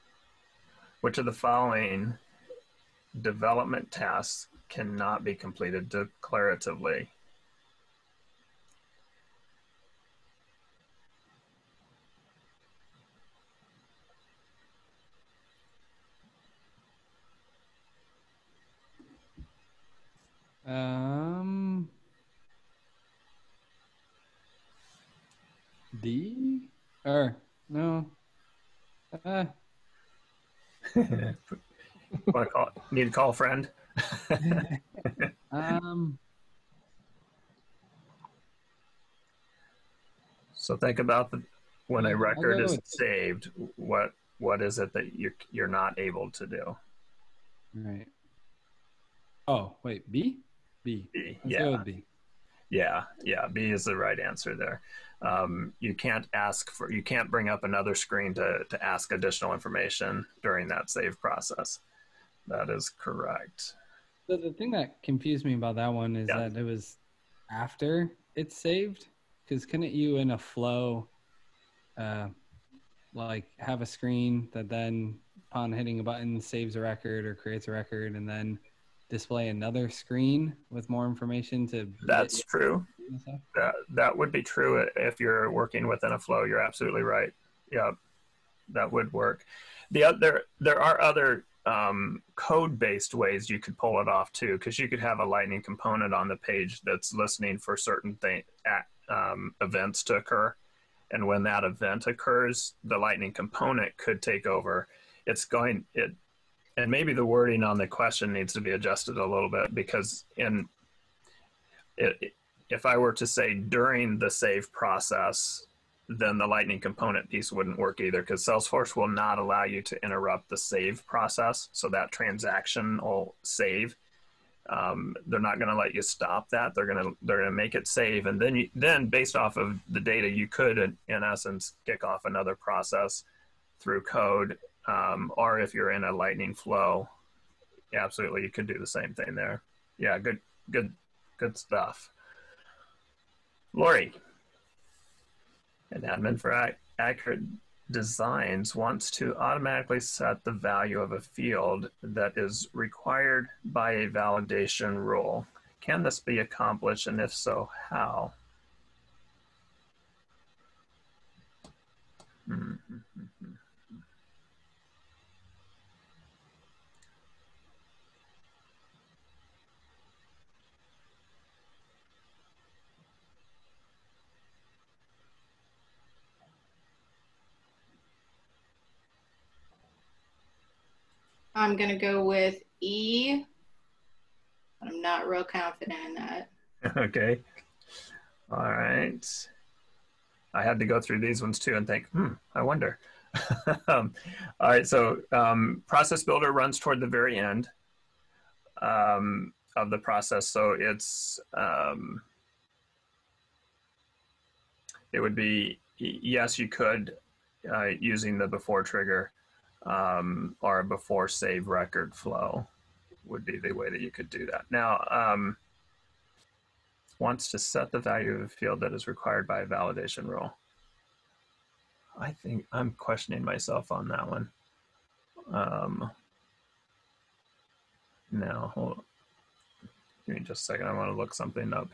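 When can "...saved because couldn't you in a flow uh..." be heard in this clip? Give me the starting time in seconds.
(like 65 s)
68 s.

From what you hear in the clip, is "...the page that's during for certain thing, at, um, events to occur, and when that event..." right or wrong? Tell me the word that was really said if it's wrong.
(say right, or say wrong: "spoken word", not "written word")
wrong: "listening", not "during".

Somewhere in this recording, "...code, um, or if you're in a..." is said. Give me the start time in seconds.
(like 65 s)
134 s.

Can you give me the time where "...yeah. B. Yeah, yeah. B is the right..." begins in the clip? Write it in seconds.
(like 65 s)
51 s.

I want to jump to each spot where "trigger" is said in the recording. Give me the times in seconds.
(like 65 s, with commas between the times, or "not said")
208 s.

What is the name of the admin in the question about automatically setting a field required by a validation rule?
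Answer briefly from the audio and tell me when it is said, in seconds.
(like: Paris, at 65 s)
Lori, at 143 s.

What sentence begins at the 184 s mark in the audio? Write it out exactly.
I'm not real confident in that.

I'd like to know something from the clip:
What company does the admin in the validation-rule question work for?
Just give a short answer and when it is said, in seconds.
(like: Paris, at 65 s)
Accurate Designs, at 146 s.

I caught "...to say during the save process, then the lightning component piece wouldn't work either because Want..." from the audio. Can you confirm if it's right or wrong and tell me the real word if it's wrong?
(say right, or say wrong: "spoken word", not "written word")
wrong: "Salesforce", not "Want".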